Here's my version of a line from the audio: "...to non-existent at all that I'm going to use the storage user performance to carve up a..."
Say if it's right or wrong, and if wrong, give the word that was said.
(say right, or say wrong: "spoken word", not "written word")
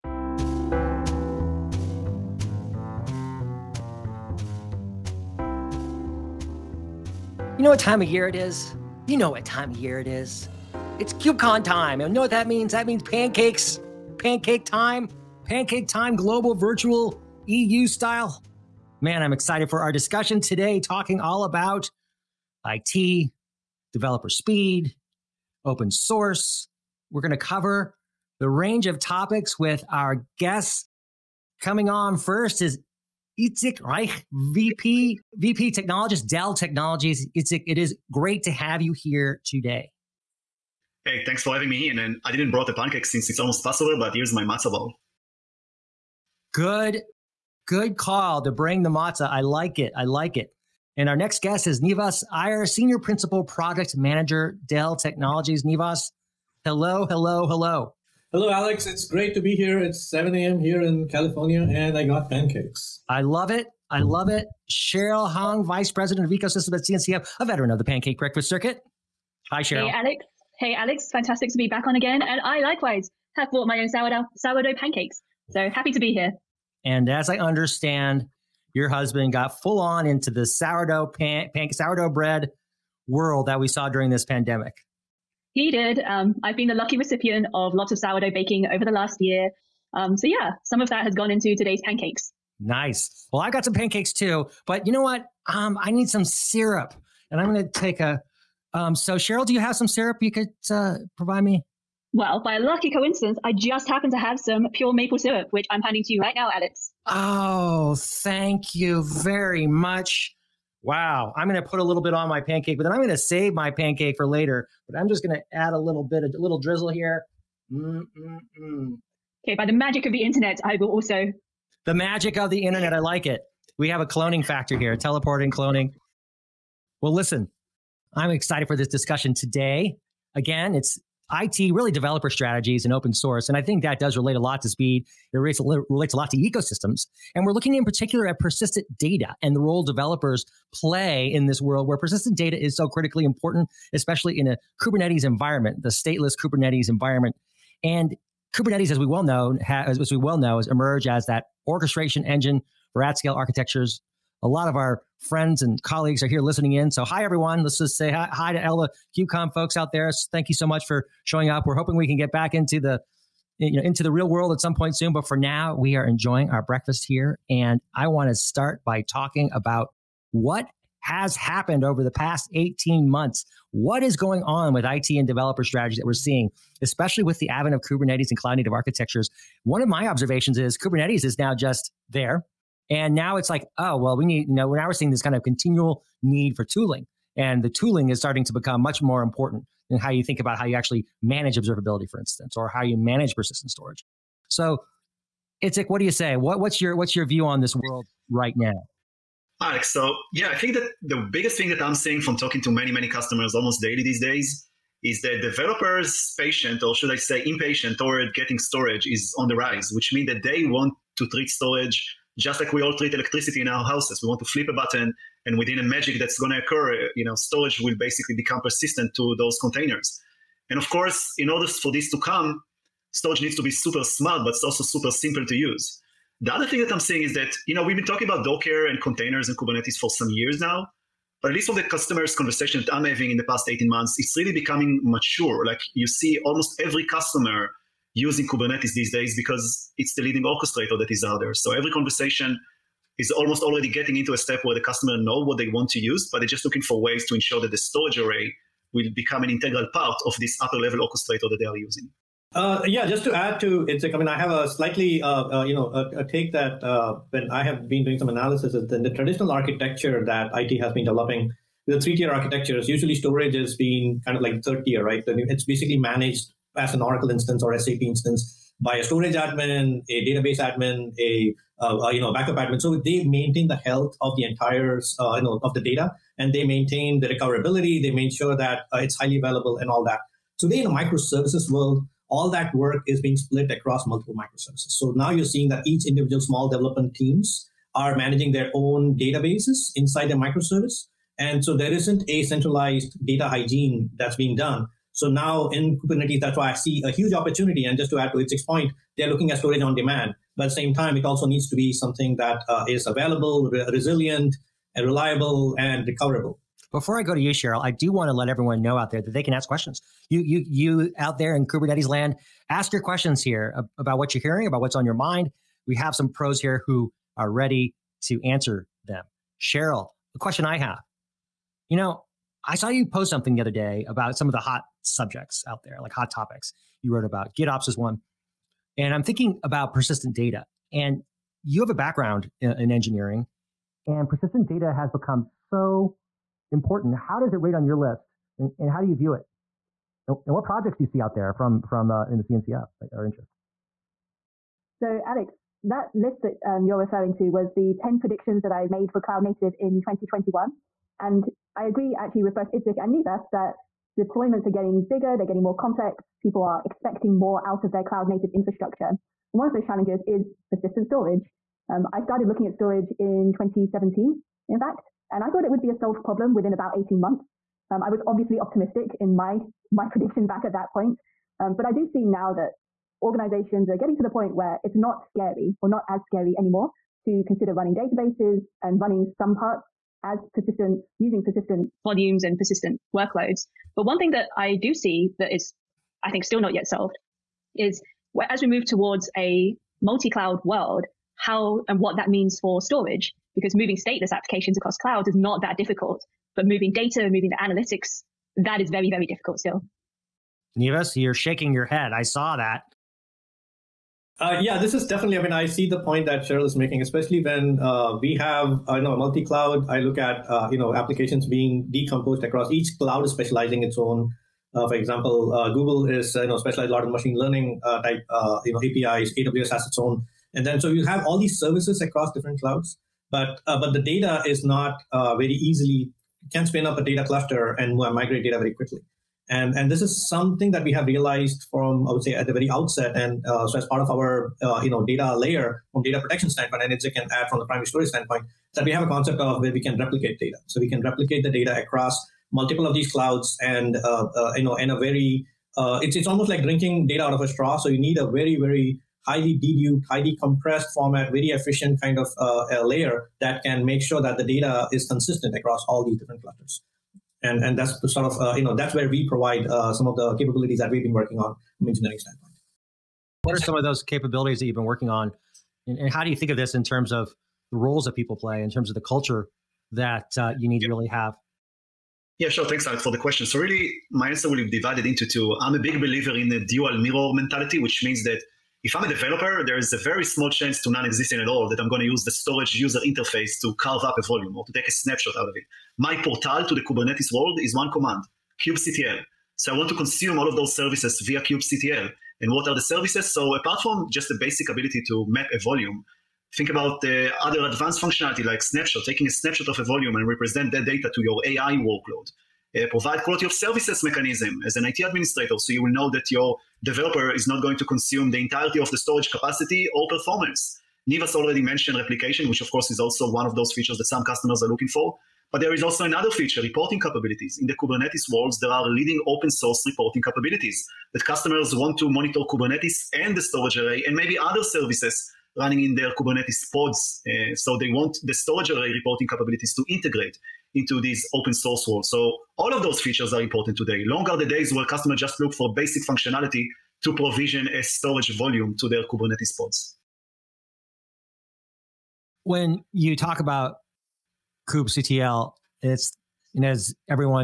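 wrong: "interface", not "performance".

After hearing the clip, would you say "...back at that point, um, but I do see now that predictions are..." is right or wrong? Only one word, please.
wrong.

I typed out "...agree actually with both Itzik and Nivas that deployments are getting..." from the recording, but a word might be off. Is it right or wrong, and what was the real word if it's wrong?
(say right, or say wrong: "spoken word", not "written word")
right.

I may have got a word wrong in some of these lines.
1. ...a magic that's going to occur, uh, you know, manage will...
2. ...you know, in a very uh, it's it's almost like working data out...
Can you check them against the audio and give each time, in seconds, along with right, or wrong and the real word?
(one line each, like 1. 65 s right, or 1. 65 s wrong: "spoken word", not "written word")
1. 215 s wrong: "storage", not "manage"
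2. 444 s wrong: "drinking", not "working".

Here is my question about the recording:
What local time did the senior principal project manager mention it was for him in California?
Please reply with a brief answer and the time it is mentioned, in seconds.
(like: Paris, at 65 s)
7 a.m., at 60 s.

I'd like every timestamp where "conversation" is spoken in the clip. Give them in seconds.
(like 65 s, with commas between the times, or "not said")
232 s, 241 s.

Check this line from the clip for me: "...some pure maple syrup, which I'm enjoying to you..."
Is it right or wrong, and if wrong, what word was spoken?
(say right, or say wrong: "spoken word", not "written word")
wrong: "handing", not "enjoying".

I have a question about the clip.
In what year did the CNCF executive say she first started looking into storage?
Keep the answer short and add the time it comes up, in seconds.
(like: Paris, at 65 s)
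2017, at 363 s.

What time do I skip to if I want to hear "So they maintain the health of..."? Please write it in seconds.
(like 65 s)
272 s.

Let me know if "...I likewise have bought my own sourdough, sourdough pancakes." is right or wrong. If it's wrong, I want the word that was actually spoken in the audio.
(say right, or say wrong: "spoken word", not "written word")
right.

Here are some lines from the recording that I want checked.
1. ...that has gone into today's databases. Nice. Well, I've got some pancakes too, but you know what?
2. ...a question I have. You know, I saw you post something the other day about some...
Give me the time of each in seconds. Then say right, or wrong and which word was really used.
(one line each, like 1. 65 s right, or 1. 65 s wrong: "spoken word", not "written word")
1. 90 s wrong: "pancakes", not "databases"
2. 320 s right.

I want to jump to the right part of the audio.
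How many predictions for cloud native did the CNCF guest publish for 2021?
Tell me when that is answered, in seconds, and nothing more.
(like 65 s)
347 s.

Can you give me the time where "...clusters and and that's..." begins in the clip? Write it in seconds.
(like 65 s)
456 s.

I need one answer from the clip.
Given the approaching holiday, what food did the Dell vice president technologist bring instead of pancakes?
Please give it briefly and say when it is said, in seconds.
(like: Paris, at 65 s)
matzo ball, at 44 s.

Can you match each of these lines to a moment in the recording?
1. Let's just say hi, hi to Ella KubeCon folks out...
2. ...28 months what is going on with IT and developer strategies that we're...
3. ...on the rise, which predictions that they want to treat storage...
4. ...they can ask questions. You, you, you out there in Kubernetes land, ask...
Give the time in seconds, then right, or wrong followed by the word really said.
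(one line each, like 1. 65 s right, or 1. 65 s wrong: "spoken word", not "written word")
1. 157 s right
2. 172 s wrong: "18", not "28"
3. 209 s wrong: "means", not "predictions"
4. 309 s right.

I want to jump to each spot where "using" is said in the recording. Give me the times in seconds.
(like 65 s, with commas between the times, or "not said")
238 s, 251 s, 381 s.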